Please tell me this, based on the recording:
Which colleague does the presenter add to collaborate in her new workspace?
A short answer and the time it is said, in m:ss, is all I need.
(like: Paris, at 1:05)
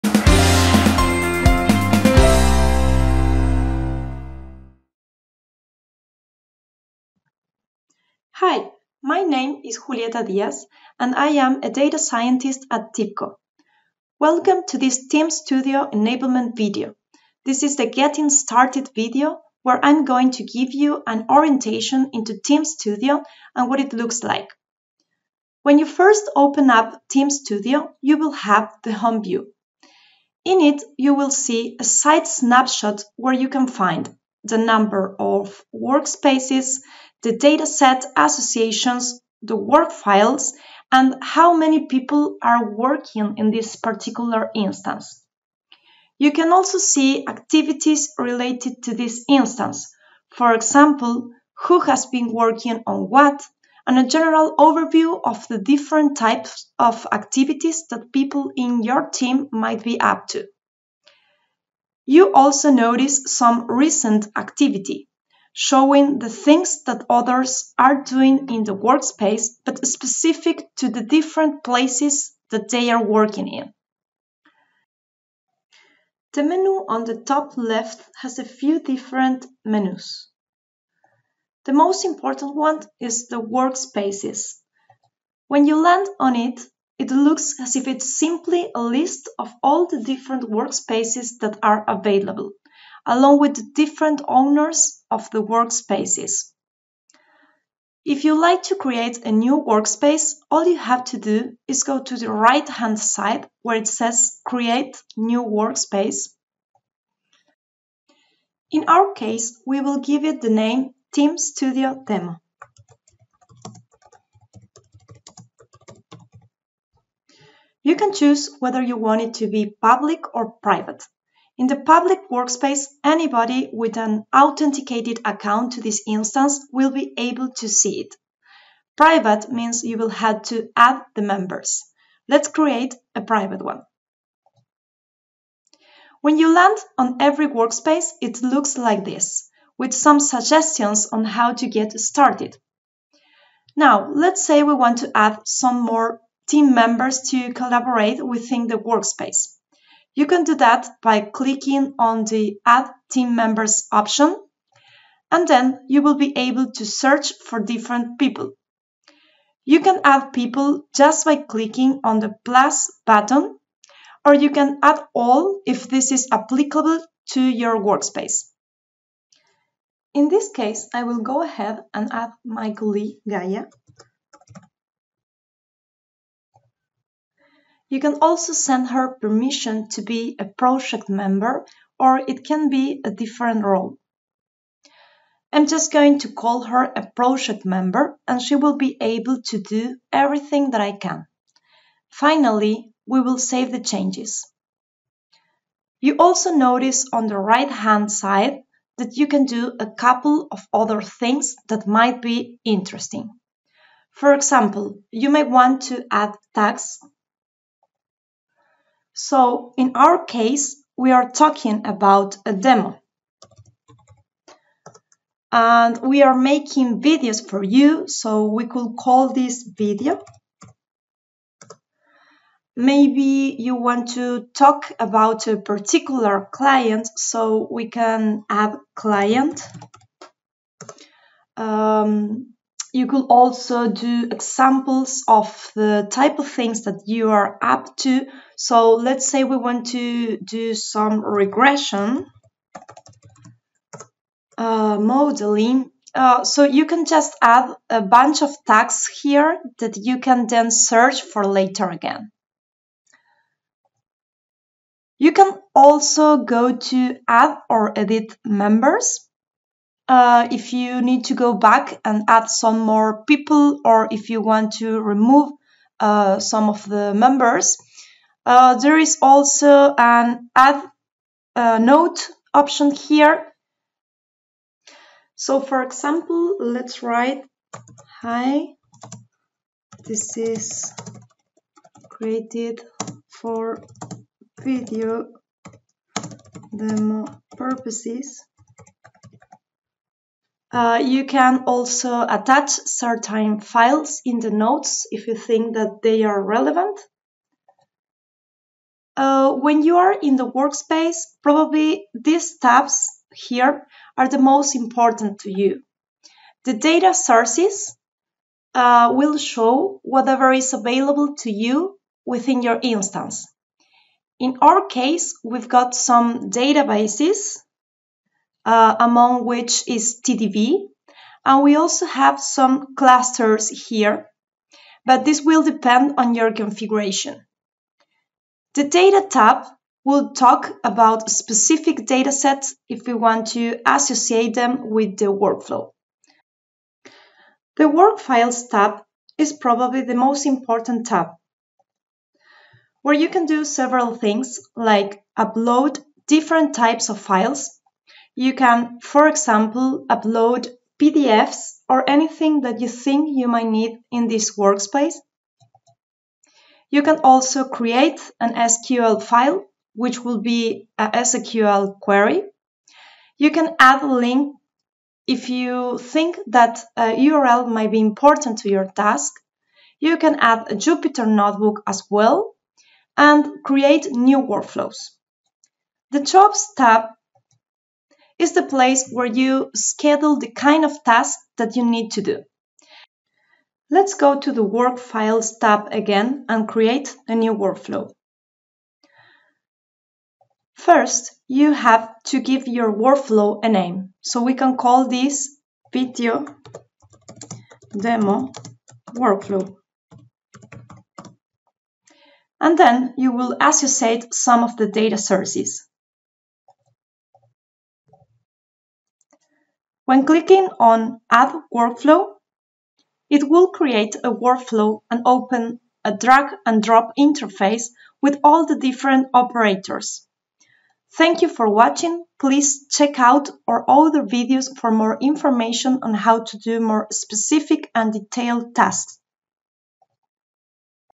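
Gaia, at 2:53.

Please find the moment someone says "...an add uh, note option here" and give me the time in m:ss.
4:29.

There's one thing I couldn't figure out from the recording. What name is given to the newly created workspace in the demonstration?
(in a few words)
Team Studio Demo.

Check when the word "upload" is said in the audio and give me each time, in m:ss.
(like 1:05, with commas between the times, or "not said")
5:45, 5:50.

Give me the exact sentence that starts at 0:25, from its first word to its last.
When you first open up Team Studio, you will have the home view.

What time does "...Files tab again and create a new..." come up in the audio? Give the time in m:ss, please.
6:24.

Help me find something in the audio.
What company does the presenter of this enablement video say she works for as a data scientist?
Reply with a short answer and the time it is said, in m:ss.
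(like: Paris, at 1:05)
TIBCO, at 0:12.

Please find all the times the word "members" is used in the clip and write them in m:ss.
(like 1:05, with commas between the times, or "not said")
2:11, 2:26, 2:33, 3:01, 3:07, 4:18, 4:27.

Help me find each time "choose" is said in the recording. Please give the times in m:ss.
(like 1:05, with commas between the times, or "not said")
1:58.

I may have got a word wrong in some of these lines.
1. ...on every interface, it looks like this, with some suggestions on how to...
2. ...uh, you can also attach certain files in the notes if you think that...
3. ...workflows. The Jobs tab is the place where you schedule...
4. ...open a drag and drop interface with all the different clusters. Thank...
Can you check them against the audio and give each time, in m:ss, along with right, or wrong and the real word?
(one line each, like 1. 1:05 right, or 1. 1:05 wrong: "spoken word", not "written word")
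1. 2:16 wrong: "workspace", not "interface"
2. 4:50 right
3. 6:14 right
4. 6:55 wrong: "operators", not "clusters".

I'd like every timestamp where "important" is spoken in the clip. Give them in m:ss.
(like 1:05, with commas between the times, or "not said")
1:22, 5:04, 5:40, 6:07.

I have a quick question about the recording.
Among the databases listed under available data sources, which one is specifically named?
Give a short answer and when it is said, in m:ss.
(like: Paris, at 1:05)
TDV, at 5:20.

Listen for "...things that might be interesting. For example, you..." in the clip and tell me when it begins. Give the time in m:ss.
3:21.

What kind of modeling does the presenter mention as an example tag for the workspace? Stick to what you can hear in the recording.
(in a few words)
regression.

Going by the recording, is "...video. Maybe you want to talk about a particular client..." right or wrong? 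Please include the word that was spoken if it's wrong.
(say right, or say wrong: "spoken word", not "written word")
right.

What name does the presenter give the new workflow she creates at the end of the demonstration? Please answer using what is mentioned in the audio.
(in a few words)
video demo workflow.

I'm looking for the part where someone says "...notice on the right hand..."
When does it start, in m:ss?
3:16.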